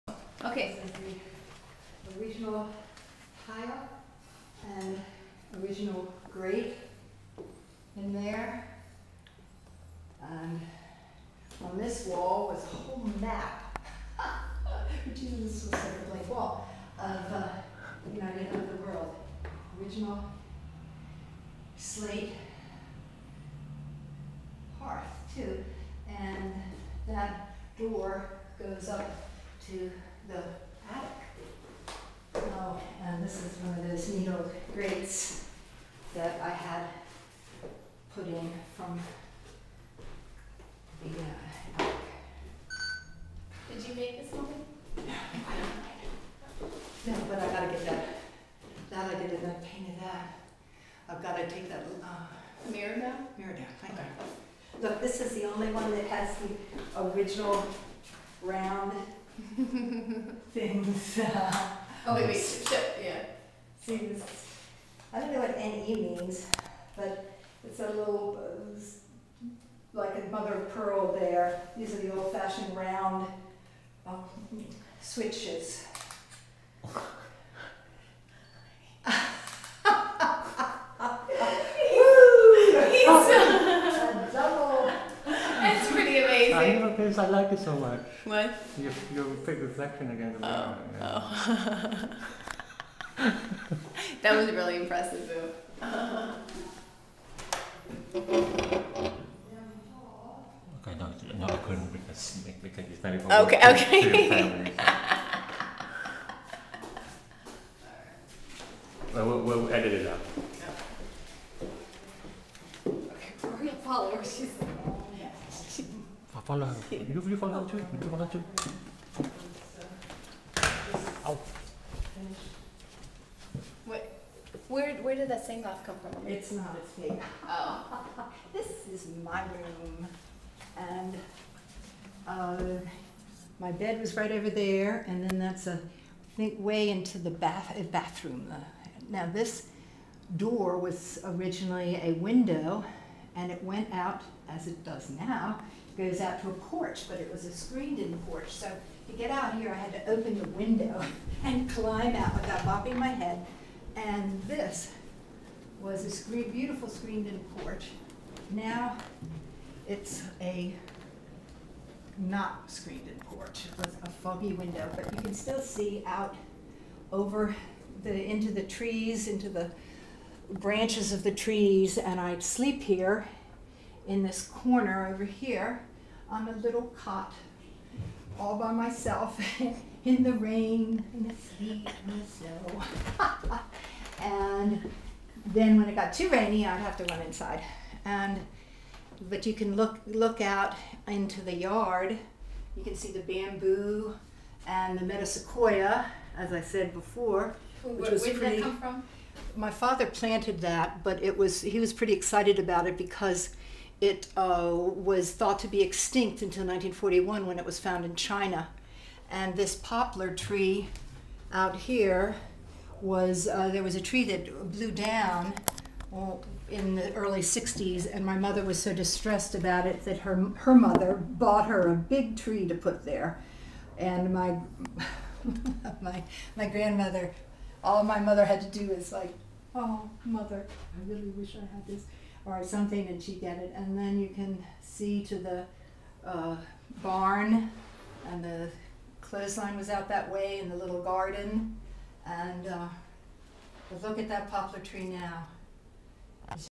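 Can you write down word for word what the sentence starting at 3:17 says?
Where, which was where did that come from?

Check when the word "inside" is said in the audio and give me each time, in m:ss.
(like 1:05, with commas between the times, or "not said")
3:07.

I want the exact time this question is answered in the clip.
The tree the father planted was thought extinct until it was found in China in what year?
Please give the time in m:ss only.
3:26.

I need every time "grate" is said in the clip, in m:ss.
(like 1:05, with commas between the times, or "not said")
0:06, 0:34.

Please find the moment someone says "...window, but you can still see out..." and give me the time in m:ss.
2:44.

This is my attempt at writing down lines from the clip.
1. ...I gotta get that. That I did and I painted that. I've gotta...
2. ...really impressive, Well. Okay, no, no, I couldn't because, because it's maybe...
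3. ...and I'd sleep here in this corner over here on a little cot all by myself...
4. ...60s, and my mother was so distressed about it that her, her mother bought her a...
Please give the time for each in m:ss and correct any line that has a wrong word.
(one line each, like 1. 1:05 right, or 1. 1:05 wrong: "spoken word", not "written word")
1. 0:47 right
2. 1:34 wrong: "Boo", not "Well"
3. 2:51 right
4. 3:37 right.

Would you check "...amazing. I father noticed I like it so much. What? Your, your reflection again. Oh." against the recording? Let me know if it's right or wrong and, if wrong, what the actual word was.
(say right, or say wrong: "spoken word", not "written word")
wrong: "never", not "father".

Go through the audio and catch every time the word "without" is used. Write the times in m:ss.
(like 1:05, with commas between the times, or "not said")
2:32.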